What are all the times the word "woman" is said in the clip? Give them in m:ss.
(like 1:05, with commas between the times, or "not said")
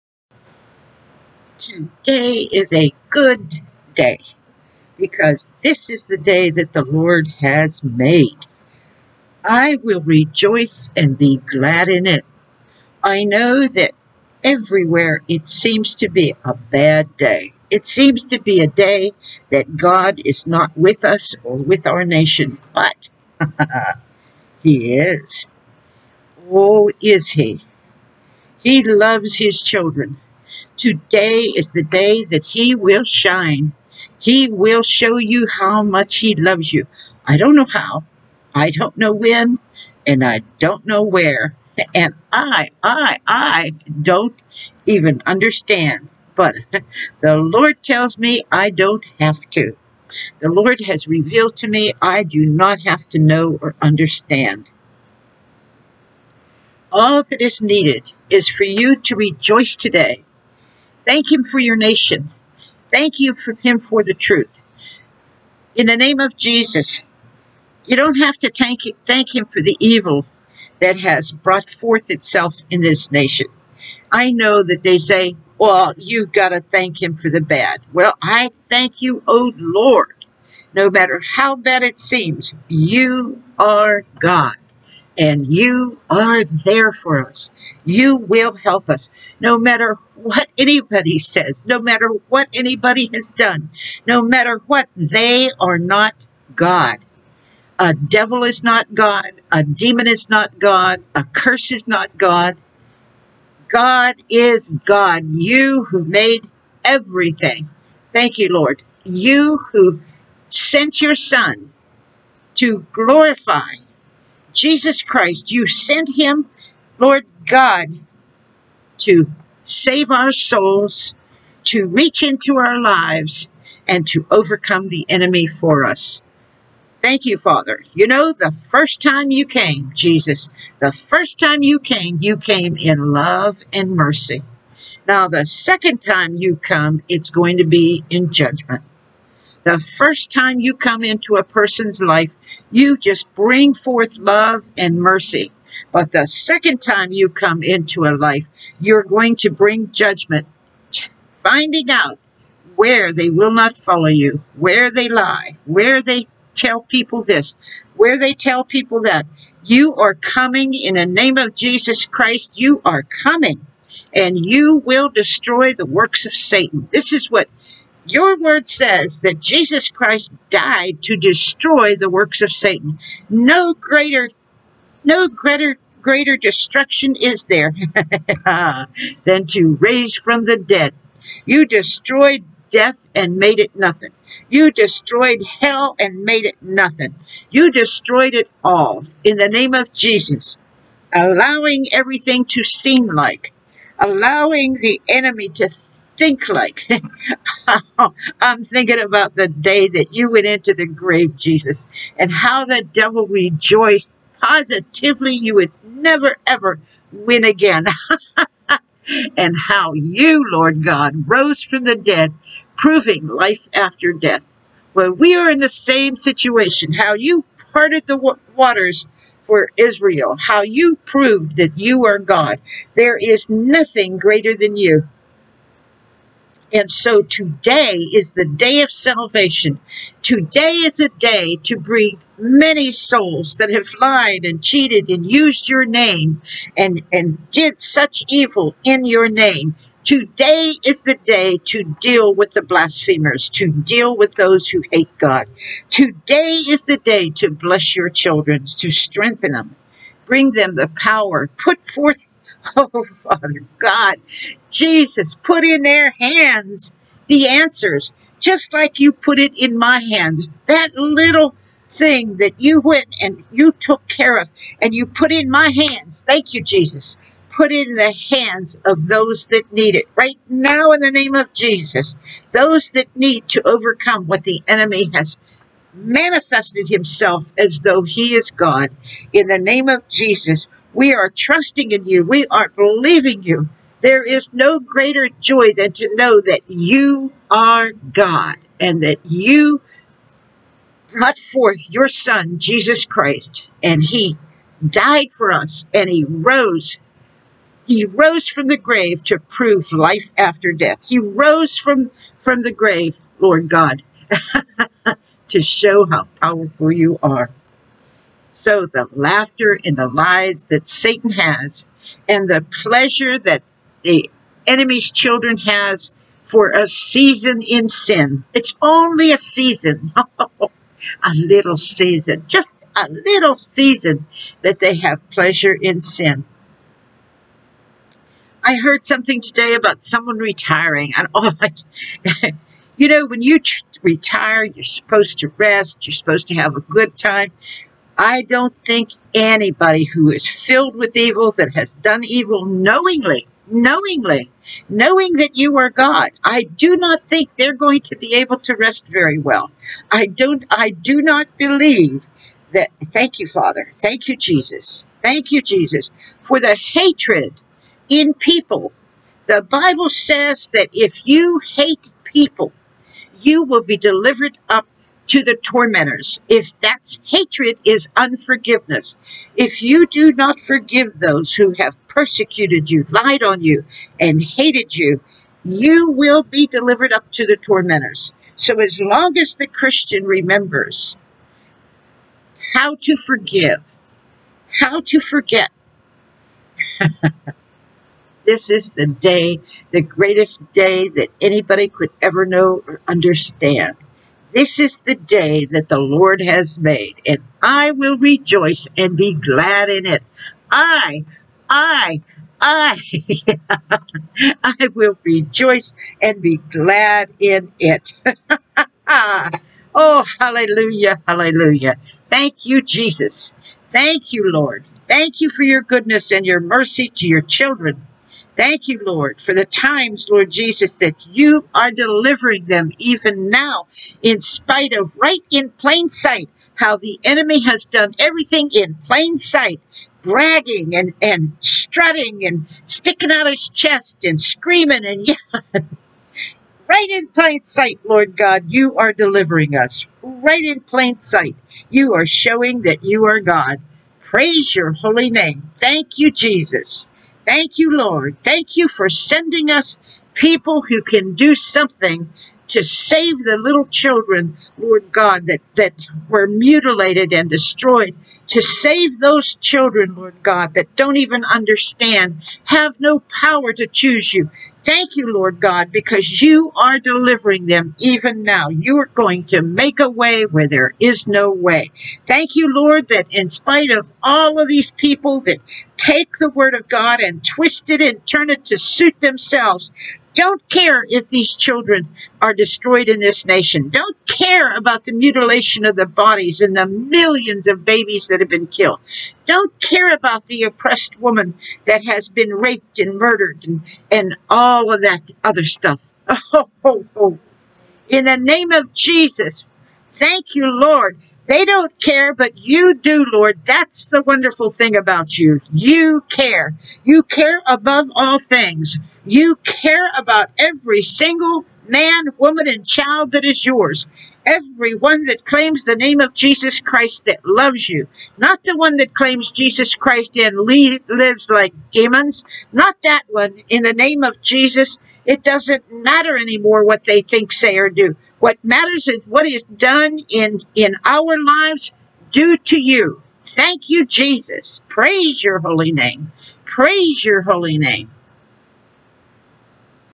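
8:11, 8:32.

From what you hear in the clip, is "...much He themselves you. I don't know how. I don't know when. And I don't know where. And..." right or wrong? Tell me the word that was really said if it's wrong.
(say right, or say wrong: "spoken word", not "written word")
wrong: "loves", not "themselves".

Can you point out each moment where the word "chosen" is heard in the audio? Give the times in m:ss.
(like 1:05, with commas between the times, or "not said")
not said.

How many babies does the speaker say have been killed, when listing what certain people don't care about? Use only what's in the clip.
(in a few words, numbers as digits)
millions.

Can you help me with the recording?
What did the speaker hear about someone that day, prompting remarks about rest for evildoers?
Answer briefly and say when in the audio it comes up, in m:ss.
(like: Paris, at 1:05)
retiring, at 5:30.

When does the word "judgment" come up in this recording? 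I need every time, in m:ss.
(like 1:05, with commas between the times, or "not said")
2:18, 2:29.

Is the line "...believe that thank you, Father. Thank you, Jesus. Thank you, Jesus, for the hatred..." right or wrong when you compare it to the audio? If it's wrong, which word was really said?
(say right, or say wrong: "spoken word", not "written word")
right.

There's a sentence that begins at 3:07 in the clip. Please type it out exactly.
You destroyed it all in the name of Jesus, allowing everything to seem like, allowing the enemy to think like.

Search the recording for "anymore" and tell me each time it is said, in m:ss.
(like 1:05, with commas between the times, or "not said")
8:46.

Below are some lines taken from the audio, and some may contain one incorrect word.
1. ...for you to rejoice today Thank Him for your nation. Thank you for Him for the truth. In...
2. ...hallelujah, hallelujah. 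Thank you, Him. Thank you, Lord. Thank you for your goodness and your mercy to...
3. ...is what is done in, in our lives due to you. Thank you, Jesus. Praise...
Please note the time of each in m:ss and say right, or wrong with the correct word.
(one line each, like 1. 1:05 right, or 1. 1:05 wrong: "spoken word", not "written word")
1. 0:58 right
2. 6:50 wrong: "Jesus", not "Him"
3. 8:49 right.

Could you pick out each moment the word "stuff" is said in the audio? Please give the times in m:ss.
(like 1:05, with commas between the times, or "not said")
8:15.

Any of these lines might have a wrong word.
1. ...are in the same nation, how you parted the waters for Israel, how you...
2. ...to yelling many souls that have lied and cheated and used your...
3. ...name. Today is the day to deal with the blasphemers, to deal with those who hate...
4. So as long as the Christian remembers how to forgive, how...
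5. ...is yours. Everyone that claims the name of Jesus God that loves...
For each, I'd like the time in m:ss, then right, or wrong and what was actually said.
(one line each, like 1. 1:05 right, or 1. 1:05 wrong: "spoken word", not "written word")
1. 3:35 wrong: "situation", not "nation"
2. 3:51 wrong: "bring", not "yelling"
3. 3:59 right
4. 6:18 right
5. 8:33 wrong: "Christ", not "God".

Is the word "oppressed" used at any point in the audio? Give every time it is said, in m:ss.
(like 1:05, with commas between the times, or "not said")
8:10.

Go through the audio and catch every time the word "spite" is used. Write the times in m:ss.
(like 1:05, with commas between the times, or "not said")
7:04, 7:53.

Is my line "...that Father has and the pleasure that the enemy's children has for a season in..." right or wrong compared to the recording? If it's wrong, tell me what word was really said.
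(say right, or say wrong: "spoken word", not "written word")
wrong: "Satan", not "Father".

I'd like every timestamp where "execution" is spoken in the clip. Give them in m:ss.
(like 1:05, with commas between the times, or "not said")
not said.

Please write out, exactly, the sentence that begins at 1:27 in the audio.
You will help us no matter what anybody says, no matter what anybody has done, no matter what.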